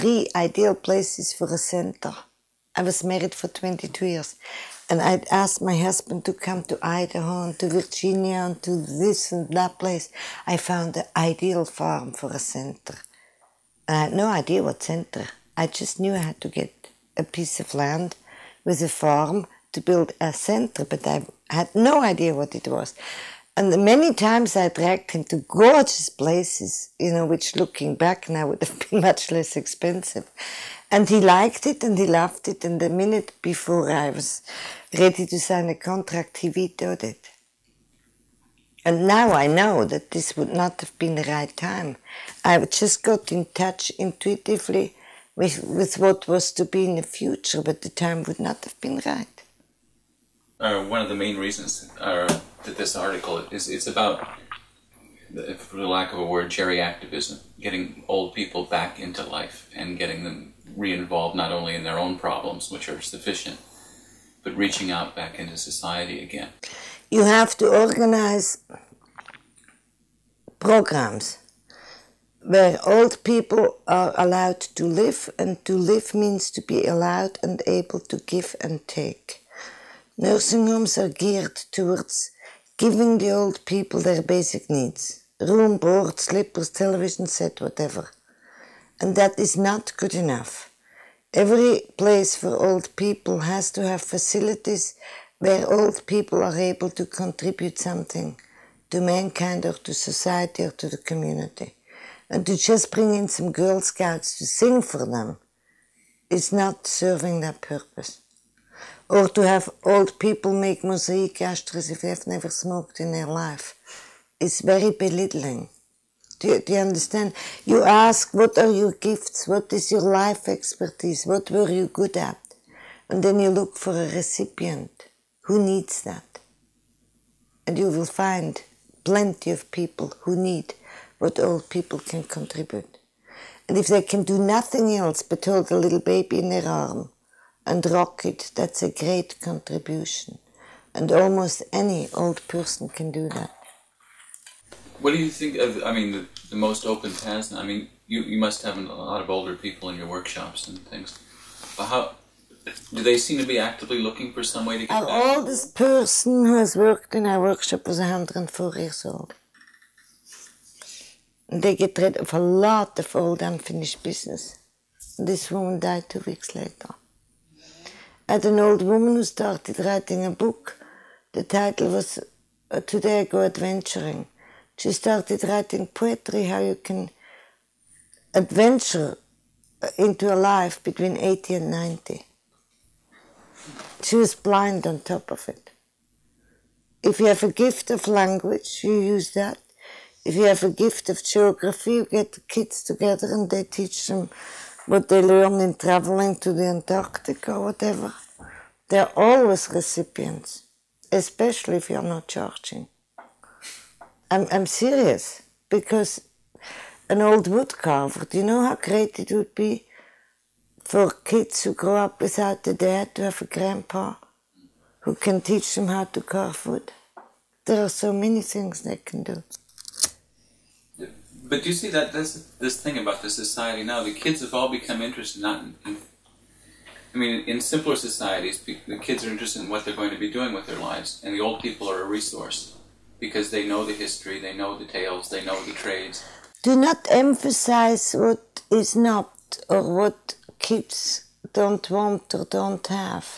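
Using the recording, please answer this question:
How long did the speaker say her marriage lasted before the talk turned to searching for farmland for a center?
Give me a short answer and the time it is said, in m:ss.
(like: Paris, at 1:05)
22 years, at 0:03.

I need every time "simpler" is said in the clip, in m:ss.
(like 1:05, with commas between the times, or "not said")
3:47.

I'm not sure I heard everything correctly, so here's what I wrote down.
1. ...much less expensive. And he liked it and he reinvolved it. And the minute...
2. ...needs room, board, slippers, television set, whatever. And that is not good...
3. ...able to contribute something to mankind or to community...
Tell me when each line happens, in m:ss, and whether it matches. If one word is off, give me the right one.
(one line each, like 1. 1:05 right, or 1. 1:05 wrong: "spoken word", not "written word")
1. 0:29 wrong: "loved", not "reinvolved"
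2. 1:24 right
3. 1:36 wrong: "society", not "community".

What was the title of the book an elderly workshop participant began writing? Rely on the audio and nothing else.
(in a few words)
Today I Go Adventuring.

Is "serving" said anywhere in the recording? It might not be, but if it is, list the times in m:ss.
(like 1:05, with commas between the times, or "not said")
1:46.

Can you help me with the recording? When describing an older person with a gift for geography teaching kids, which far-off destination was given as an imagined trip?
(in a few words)
Antarctic.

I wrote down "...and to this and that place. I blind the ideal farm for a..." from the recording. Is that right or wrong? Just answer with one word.
wrong.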